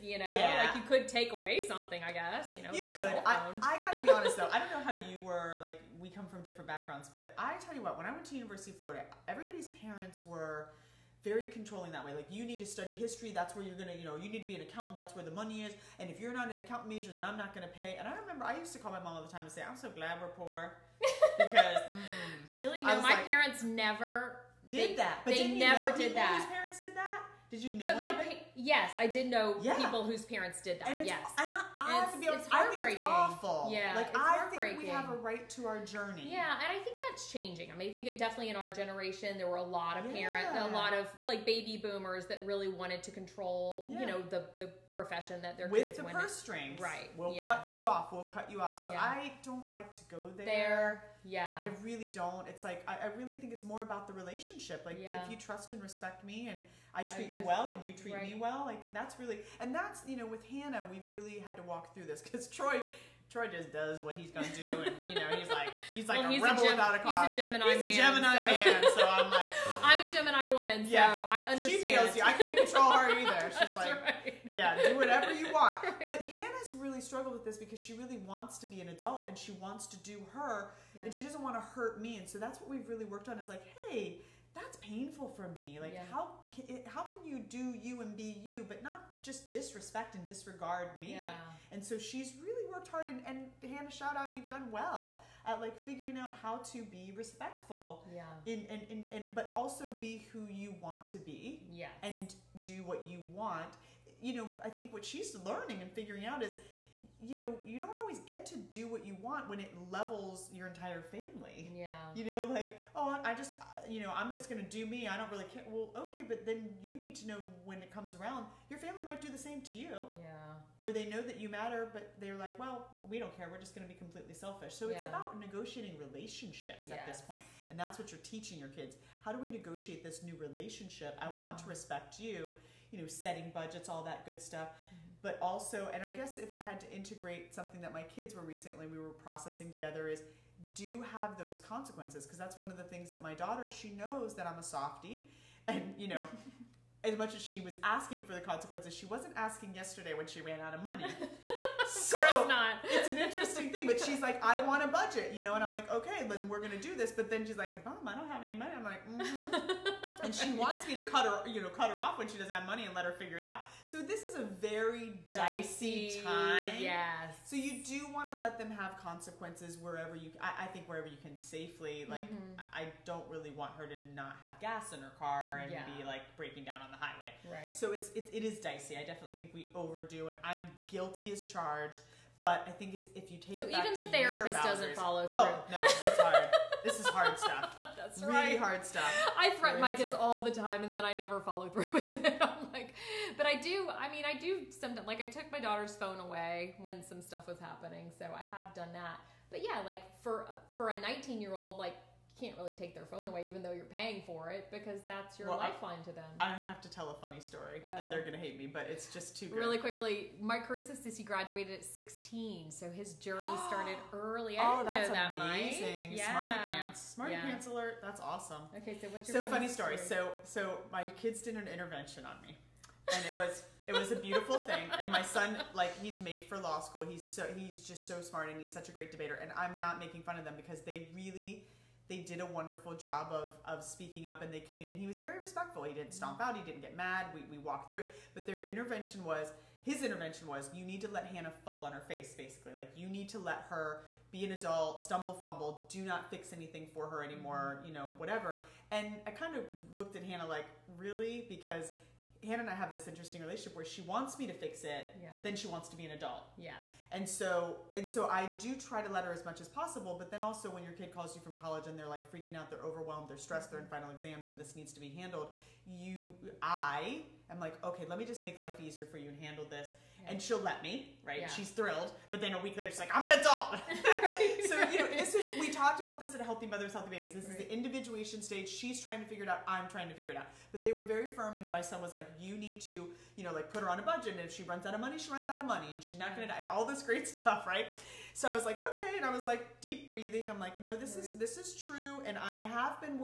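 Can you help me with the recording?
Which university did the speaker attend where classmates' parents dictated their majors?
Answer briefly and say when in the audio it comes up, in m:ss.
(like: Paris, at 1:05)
University of Florida, at 0:08.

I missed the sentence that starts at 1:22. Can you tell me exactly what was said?
And so that's what we've really worked on is like, hey, that's painful for me.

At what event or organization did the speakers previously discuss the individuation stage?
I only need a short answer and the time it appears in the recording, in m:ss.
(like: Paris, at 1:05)
Healthy Mothers, Healthy Babies, at 4:36.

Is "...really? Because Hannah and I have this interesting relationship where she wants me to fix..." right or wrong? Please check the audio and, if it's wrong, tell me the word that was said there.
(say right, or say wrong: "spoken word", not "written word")
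right.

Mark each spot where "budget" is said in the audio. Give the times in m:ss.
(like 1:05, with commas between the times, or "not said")
2:13, 2:34, 4:44.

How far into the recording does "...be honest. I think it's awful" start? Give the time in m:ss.
0:32.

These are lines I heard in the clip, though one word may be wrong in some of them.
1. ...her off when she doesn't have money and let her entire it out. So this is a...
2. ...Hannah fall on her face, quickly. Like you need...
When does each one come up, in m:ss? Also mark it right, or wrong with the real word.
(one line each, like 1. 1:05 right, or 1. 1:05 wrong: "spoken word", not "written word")
1. 2:41 wrong: "figure", not "entire"
2. 4:01 wrong: "basically", not "quickly".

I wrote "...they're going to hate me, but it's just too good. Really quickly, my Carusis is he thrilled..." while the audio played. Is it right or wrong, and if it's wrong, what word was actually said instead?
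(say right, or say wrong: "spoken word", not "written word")
wrong: "graduated", not "thrilled".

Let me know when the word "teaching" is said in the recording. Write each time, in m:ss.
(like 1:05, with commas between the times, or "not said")
2:08.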